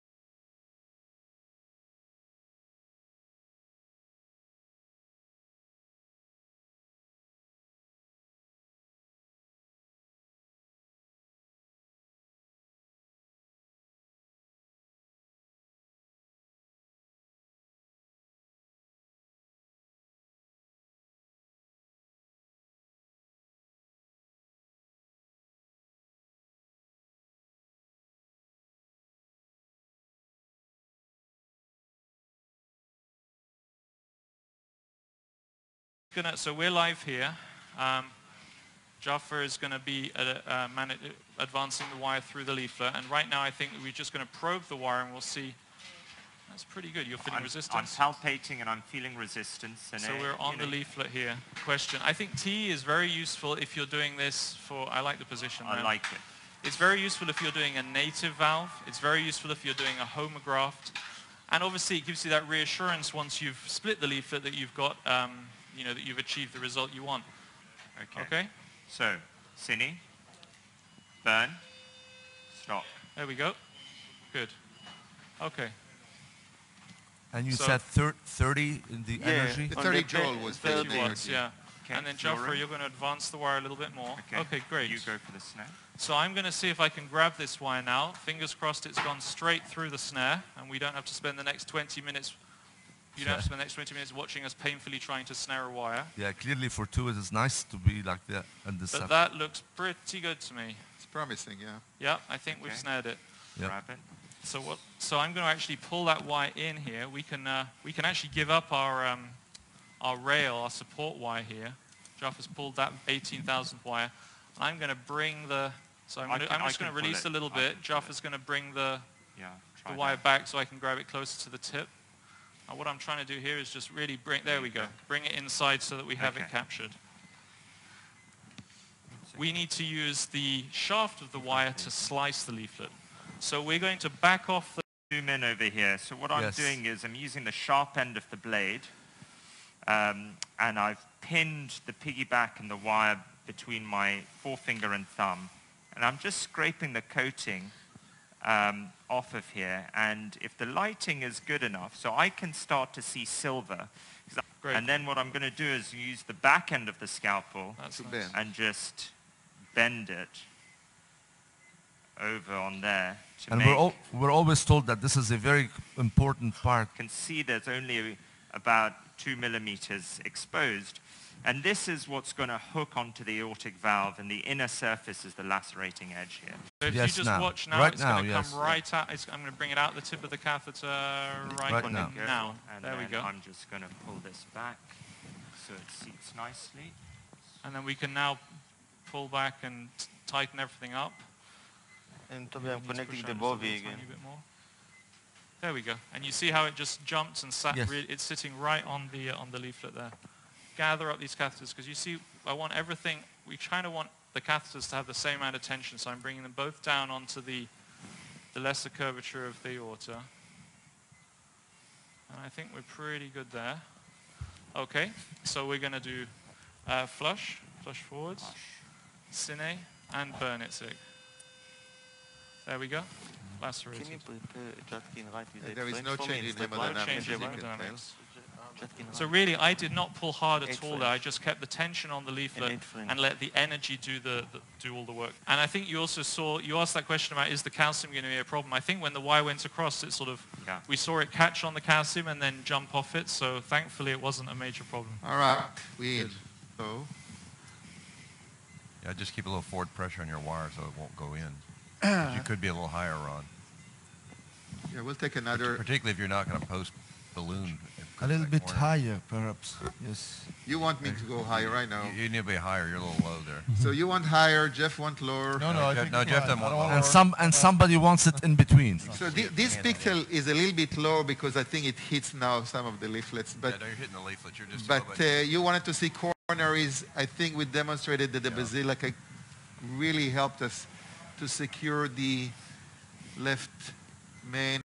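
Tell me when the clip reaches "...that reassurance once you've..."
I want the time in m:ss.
1:02.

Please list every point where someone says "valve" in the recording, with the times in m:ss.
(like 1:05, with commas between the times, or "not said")
0:58, 2:53.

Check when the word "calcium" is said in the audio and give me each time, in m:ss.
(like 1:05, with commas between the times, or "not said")
3:57, 4:01.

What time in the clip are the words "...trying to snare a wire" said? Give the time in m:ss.
1:34.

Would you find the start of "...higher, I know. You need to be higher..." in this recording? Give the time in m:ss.
4:21.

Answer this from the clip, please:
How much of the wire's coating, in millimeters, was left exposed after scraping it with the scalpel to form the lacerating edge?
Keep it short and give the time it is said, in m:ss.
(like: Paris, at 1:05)
2 millimeters, at 2:49.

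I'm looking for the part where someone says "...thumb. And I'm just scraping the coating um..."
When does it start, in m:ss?
2:25.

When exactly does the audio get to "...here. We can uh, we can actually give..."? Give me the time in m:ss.
1:46.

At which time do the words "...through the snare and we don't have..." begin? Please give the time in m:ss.
1:29.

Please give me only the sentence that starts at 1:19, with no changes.
The 30 joule was 30 the watts, energy.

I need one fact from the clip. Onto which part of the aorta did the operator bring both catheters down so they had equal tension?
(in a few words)
lesser curvature.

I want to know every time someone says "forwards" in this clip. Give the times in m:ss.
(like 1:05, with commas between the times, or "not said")
3:38, 4:09.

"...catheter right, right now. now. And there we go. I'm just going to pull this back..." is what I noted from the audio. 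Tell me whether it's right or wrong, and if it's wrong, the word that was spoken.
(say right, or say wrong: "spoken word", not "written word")
right.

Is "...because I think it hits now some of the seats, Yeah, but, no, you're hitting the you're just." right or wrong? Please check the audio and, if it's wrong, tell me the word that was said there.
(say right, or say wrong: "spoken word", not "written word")
wrong: "leaflets", not "seats".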